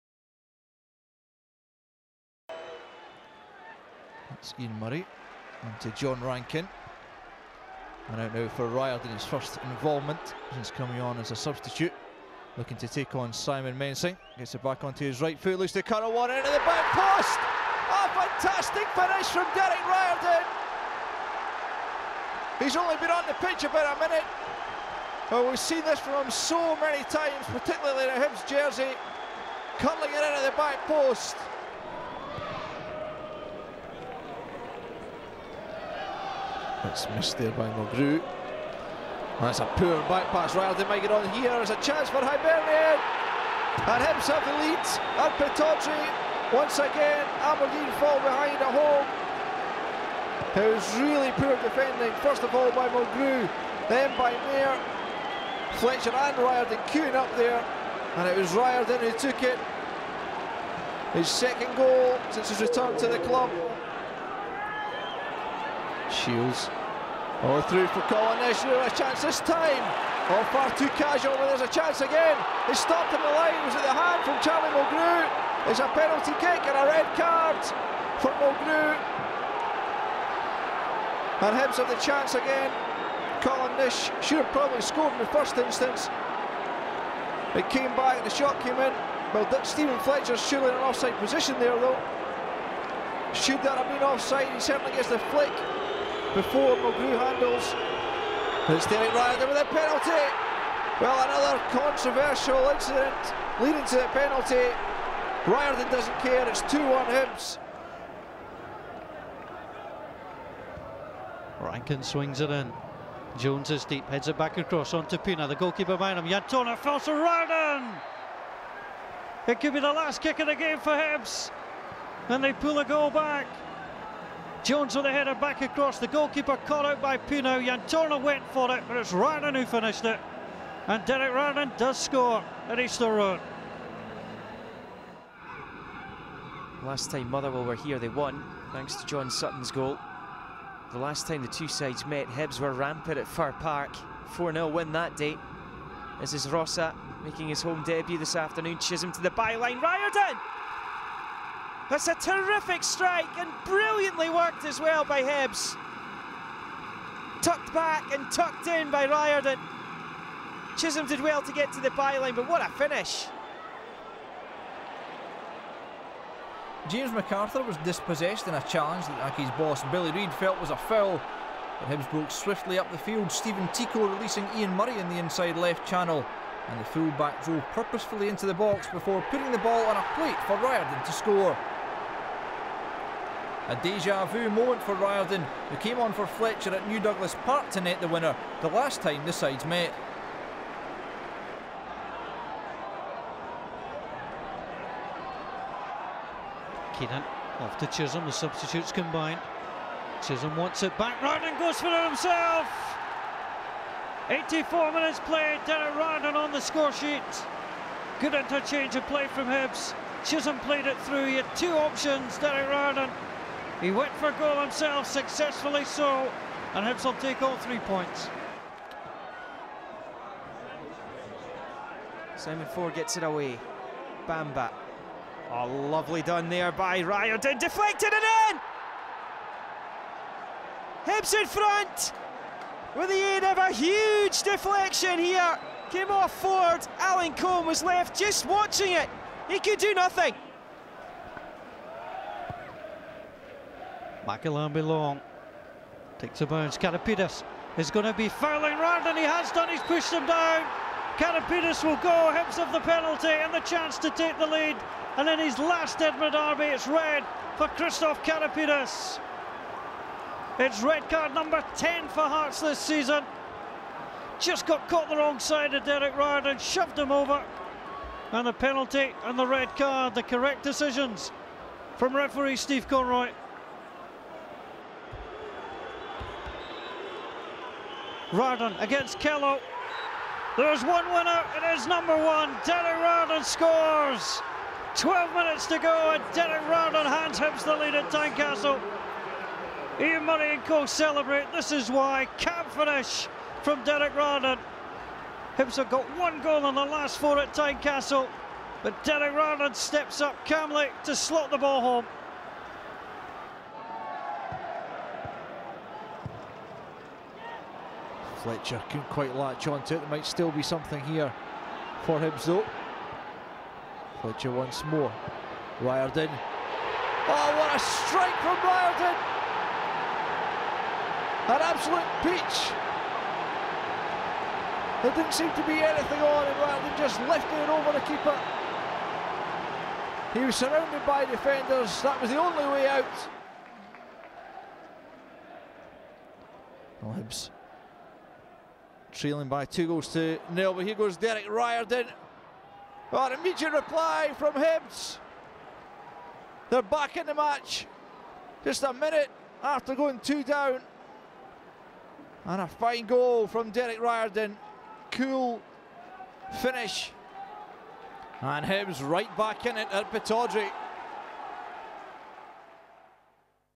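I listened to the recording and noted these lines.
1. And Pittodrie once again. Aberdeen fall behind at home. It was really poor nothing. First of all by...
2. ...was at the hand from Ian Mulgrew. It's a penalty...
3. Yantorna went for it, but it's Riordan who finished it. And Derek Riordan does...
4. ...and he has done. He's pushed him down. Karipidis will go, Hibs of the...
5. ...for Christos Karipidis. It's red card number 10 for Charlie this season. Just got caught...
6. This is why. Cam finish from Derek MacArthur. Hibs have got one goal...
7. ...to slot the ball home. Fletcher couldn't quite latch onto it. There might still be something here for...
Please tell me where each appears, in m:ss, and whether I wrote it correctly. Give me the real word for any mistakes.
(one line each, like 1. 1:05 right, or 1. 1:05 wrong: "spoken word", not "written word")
1. 0:45 wrong: "defending", not "nothing"
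2. 1:13 wrong: "Charlie", not "Ian"
3. 2:07 right
4. 4:09 right
5. 4:17 wrong: "Hearts", not "Charlie"
6. 4:51 wrong: "Riordan", not "MacArthur"
7. 5:01 right.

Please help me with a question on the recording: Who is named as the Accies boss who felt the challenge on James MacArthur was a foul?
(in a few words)
Billy Reid.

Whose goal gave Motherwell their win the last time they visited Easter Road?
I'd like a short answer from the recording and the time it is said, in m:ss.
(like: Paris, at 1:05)
John Sutton, at 2:19.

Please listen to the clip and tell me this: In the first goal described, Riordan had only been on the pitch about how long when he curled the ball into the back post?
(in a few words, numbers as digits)
About a minute.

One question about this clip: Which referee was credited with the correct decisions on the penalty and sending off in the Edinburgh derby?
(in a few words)
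Steve Conroy.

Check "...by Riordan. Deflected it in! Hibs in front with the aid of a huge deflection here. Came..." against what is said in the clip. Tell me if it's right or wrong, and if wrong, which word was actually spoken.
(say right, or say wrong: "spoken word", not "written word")
right.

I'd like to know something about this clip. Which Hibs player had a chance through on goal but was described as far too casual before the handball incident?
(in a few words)
Colin Nish.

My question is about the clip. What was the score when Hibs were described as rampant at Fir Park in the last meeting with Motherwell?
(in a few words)
4-0.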